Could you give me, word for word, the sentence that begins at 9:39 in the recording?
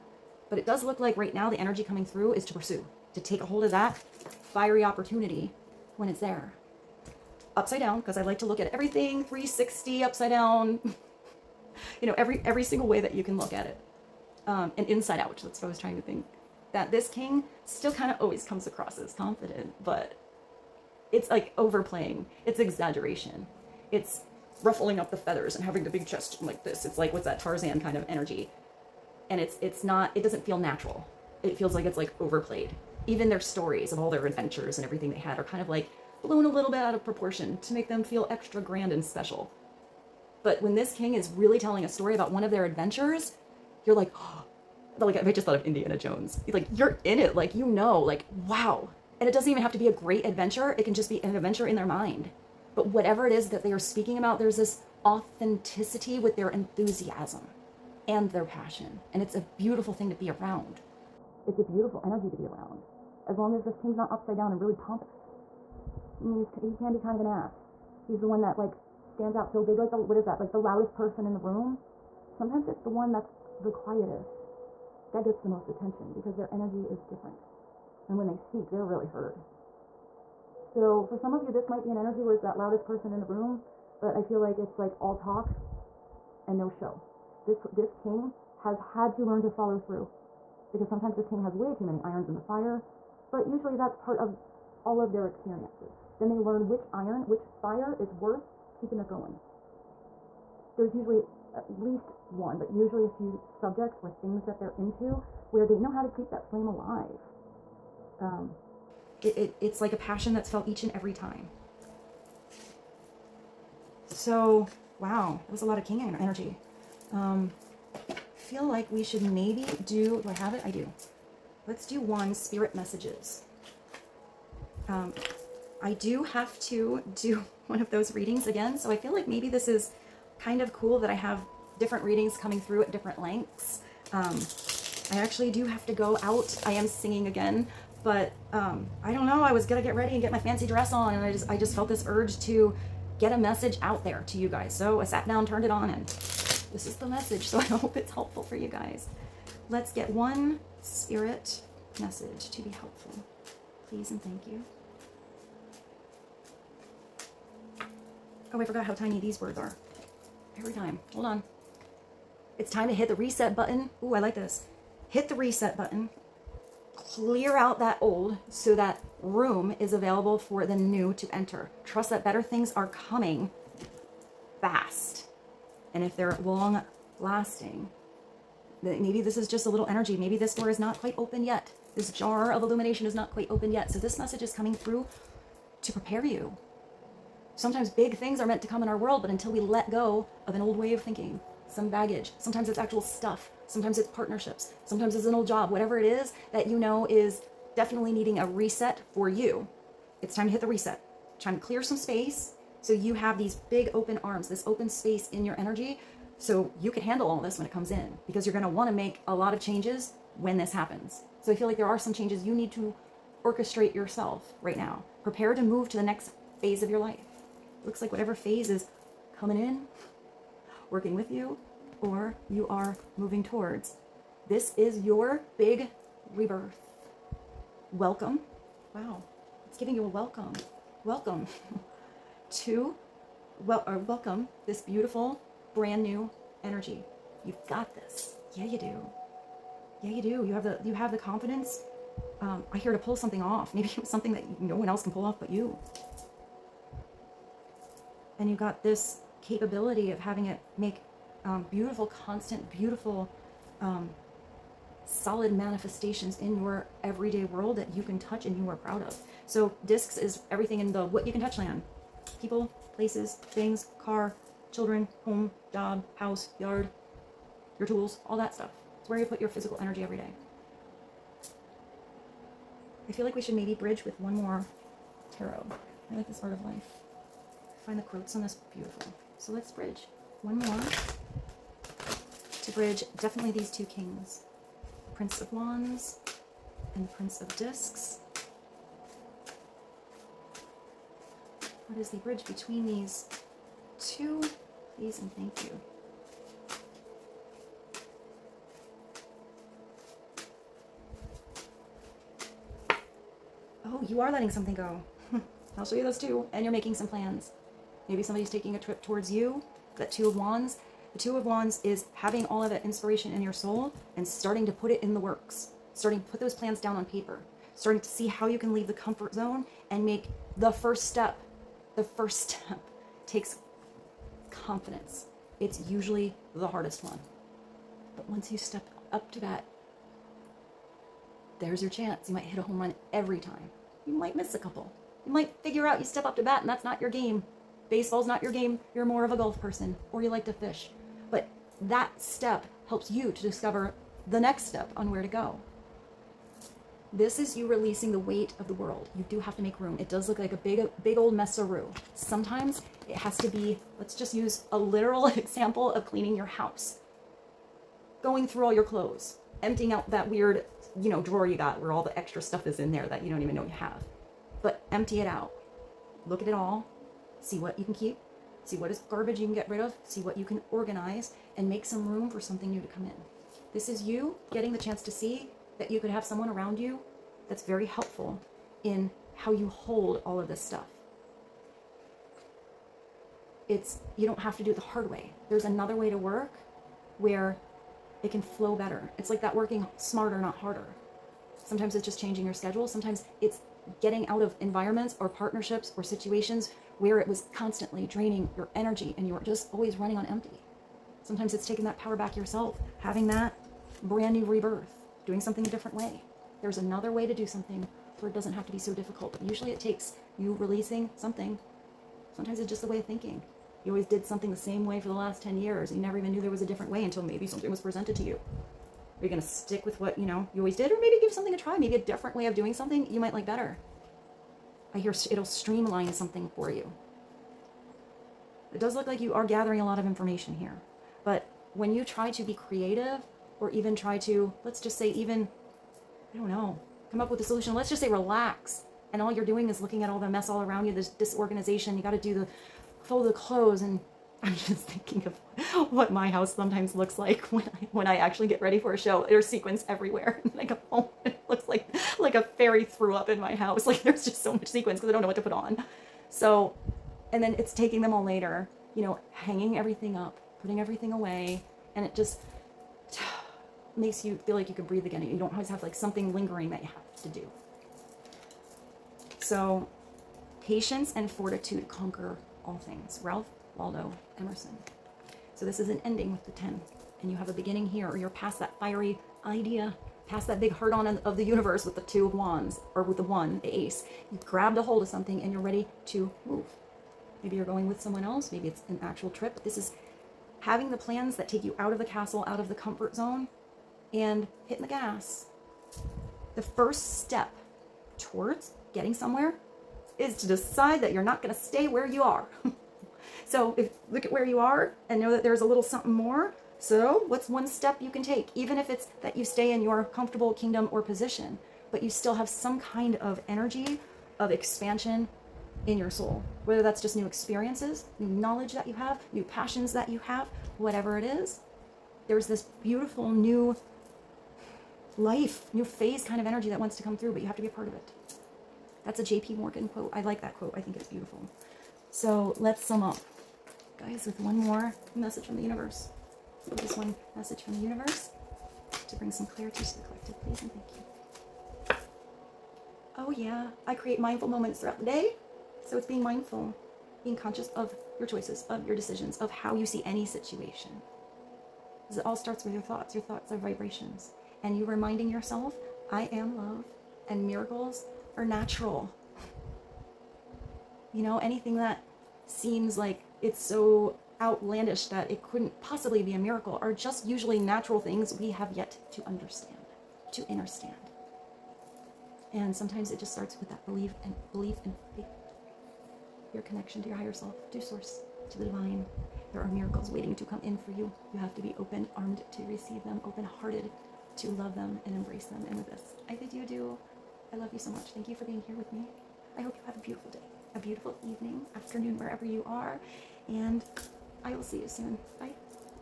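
There are miracles waiting to come in for you.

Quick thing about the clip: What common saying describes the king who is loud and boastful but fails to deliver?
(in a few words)
all talk and no show.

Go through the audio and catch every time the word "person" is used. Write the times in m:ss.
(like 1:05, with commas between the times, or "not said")
1:10, 1:22, 5:39.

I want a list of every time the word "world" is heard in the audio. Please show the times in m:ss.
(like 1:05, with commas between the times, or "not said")
3:08, 4:17, 5:48.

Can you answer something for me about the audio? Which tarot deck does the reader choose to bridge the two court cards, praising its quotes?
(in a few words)
Art of Life.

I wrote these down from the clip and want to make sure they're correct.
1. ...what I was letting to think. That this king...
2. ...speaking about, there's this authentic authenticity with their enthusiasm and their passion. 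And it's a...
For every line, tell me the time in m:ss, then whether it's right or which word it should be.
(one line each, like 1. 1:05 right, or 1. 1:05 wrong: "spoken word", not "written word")
1. 0:15 wrong: "trying", not "letting"
2. 0:53 right.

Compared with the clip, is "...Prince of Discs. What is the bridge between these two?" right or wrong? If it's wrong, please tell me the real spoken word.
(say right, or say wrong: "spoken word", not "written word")
right.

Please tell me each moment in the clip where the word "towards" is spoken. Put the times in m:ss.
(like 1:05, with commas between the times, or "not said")
3:43, 5:09, 8:18.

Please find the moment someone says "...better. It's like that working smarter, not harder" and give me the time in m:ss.
6:28.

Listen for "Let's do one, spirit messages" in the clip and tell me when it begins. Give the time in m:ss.
2:01.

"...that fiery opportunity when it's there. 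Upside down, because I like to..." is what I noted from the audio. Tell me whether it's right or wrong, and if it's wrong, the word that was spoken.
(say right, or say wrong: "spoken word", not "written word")
right.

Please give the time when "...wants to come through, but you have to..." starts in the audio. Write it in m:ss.
8:46.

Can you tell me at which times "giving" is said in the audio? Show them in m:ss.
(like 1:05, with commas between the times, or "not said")
3:49.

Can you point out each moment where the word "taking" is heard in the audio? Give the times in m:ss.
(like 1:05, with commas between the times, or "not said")
5:08, 6:41, 7:37.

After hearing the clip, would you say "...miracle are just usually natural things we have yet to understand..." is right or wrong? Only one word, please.
right.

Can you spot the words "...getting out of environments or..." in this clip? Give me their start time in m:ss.
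6:33.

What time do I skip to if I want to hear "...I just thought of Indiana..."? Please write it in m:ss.
0:45.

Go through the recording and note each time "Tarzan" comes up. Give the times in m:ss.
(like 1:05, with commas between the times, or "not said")
0:27.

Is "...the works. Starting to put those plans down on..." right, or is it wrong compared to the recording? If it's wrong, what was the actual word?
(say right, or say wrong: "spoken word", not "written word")
right.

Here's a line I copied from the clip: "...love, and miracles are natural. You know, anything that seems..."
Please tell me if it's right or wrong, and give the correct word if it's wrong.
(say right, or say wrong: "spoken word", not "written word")
right.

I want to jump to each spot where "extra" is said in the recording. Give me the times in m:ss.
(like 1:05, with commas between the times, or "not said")
0:38, 6:02.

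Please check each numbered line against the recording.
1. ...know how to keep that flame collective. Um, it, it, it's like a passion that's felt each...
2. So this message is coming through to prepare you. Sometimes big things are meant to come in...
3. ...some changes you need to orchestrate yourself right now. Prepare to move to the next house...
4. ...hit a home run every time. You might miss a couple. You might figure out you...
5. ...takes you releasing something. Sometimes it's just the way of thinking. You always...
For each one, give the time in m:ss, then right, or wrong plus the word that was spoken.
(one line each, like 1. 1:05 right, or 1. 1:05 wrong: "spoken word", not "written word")
1. 1:45 wrong: "alive", not "collective"
2. 3:03 right
3. 3:31 wrong: "phase", not "house"
4. 5:32 right
5. 6:49 right.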